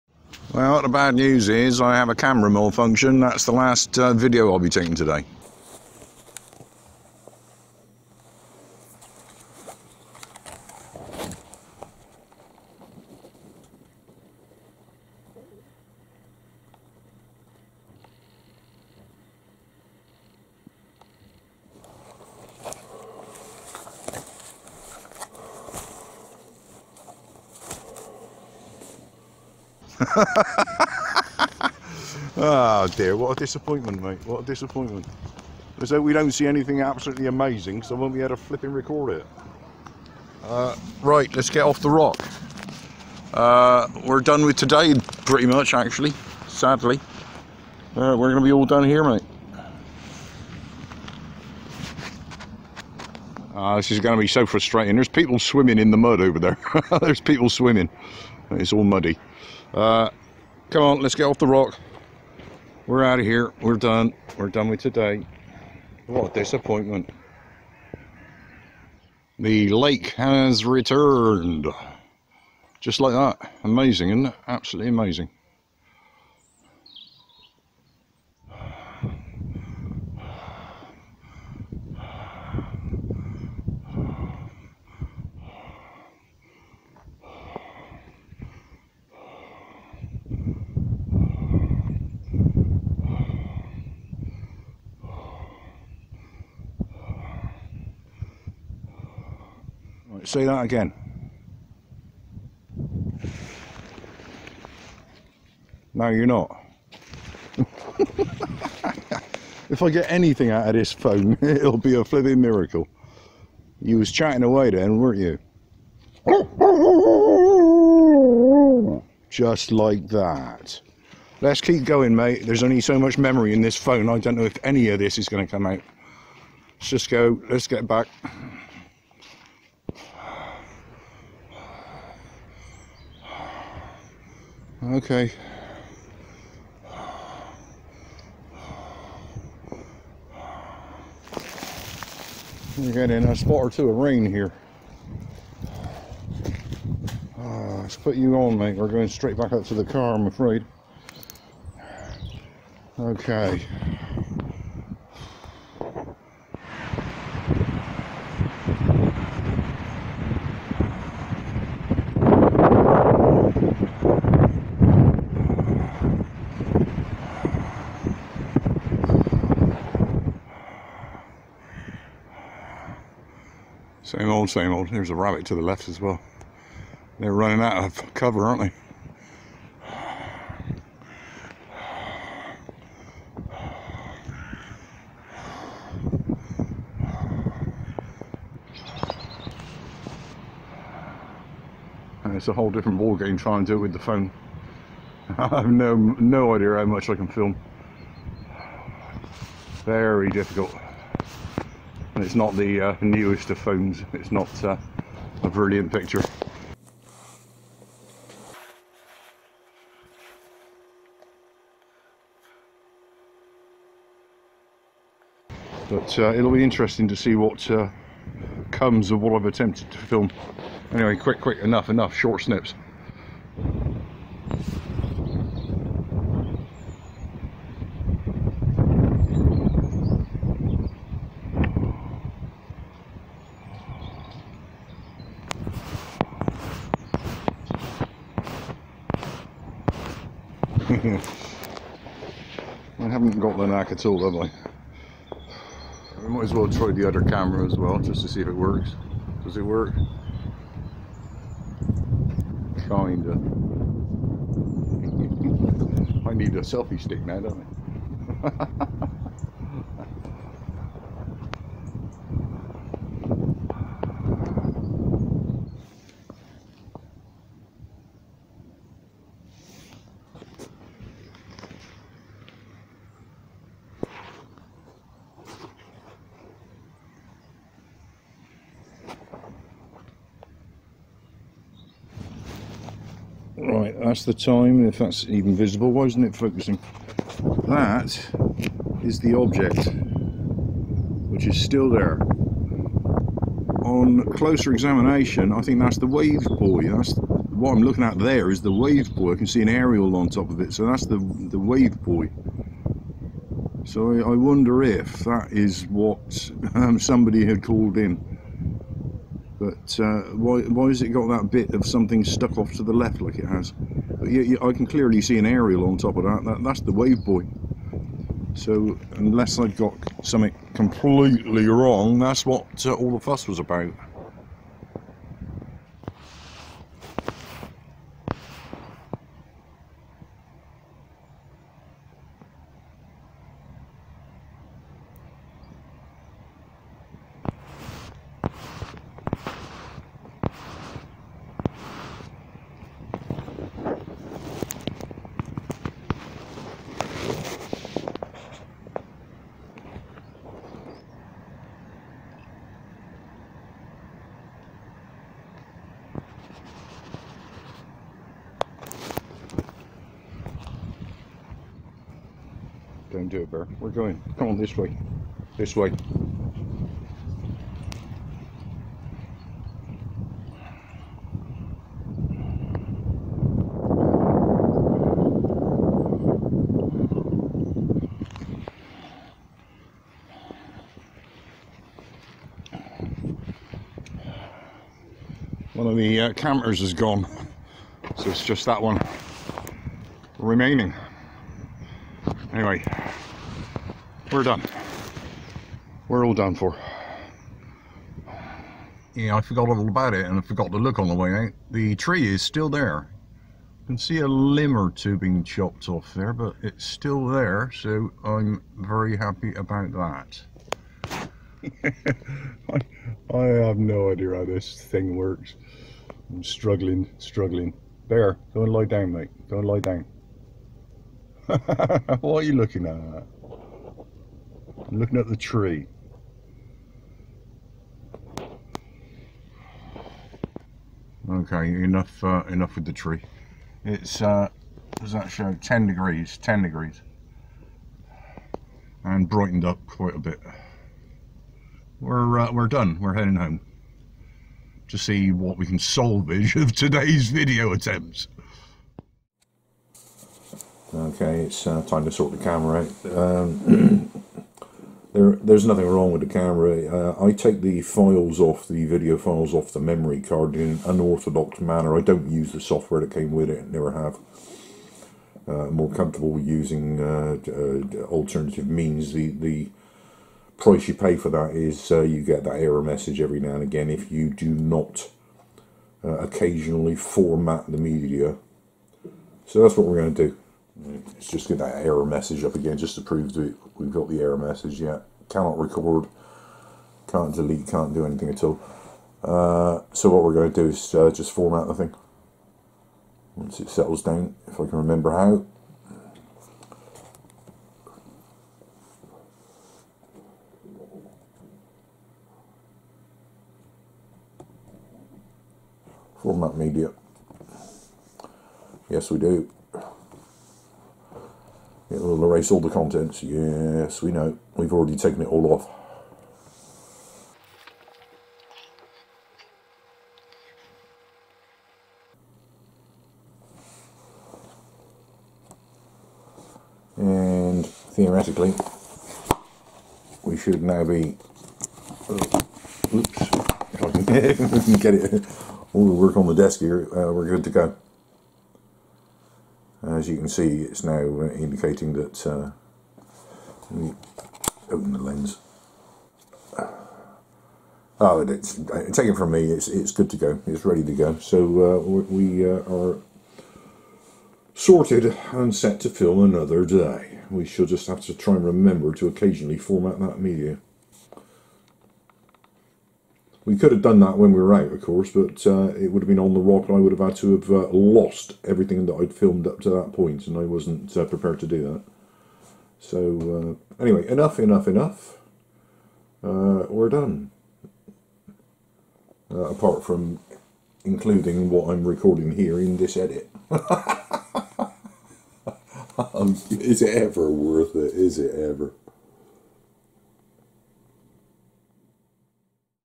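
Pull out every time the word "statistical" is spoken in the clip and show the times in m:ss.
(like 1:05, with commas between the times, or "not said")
not said.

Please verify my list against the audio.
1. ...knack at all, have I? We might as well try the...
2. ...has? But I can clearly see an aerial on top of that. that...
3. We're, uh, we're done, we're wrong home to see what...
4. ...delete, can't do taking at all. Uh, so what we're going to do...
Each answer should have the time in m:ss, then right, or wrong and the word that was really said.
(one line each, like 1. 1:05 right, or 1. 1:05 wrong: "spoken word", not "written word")
1. 4:03 right
2. 5:13 right
3. 7:21 wrong: "heading", not "wrong"
4. 8:07 wrong: "anything", not "taking".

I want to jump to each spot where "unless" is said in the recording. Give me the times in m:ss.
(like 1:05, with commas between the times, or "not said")
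5:19.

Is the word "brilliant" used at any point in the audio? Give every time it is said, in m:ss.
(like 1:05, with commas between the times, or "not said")
3:25.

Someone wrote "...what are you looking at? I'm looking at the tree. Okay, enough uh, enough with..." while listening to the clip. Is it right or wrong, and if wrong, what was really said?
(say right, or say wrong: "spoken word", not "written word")
right.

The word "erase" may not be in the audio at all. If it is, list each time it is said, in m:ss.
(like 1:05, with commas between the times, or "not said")
8:32.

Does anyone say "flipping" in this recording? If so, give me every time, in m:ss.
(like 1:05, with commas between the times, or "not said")
1:52.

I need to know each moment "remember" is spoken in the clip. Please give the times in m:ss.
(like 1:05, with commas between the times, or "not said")
8:14, 9:18.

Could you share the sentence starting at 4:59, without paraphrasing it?
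I can see an aerial on top of it, so that's the, the wave buoy.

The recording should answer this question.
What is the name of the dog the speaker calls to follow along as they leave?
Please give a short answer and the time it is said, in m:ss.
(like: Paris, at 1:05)
Bear, at 6:03.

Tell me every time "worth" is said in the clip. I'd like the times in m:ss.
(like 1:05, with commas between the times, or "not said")
9:47.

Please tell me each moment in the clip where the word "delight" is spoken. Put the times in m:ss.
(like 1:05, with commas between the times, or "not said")
not said.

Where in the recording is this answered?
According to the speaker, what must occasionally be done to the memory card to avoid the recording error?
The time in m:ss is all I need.
7:56.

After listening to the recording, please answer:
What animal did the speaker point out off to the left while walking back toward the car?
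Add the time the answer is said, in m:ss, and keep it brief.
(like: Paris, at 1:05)
Rabbit, at 2:55.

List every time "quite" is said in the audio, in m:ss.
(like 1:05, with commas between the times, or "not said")
7:19.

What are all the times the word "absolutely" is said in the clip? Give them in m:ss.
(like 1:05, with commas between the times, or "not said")
0:36, 1:14.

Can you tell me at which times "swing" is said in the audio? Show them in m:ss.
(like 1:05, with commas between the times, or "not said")
not said.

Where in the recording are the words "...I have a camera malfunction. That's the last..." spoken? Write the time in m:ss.
0:01.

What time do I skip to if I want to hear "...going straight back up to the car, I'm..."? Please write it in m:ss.
2:28.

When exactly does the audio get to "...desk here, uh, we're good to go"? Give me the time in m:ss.
8:56.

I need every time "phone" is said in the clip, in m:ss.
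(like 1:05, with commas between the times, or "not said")
1:50, 2:03, 3:13, 3:23.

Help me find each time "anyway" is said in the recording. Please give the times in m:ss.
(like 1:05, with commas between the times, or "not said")
3:40, 6:32, 9:33.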